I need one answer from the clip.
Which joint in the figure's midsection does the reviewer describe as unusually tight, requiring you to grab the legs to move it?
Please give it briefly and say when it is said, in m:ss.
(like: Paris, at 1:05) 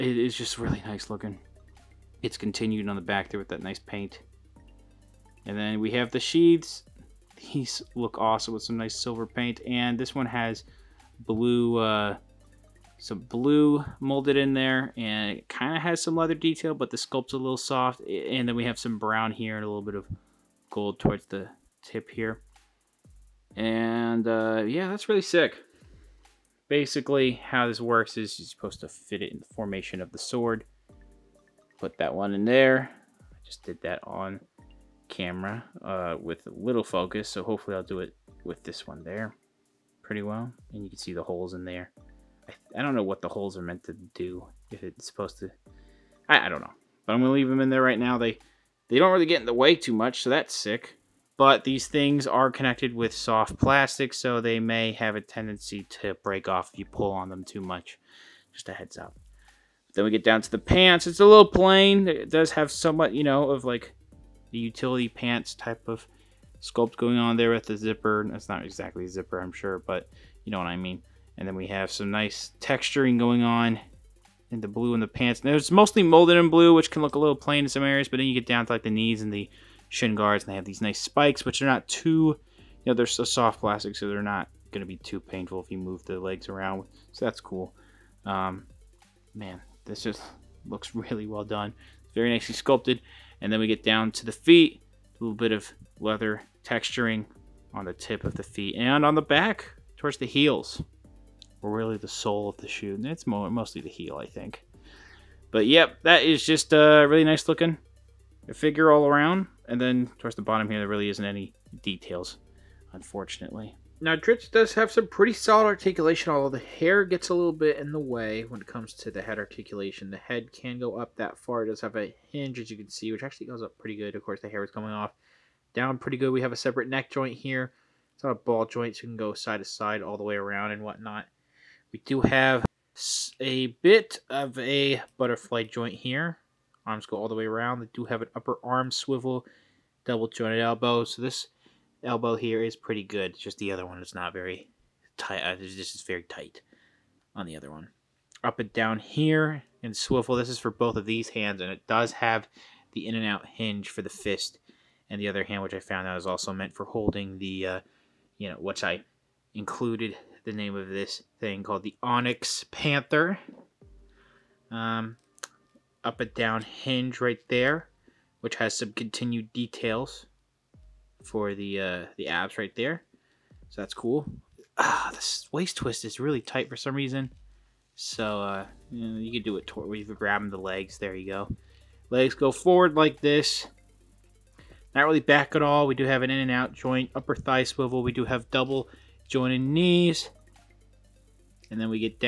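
waist twist, at 2:55.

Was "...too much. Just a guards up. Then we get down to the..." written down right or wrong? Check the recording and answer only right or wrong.
wrong.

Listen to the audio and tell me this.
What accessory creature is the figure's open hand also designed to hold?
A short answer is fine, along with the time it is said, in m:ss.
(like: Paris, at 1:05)
Onyx Panther, at 2:42.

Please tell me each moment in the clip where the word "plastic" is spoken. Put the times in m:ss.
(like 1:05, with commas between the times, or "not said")
0:53, 1:23.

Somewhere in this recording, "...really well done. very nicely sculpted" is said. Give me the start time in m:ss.
1:30.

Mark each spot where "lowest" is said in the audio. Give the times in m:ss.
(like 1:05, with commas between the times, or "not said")
not said.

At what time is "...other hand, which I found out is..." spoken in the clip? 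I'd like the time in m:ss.
2:35.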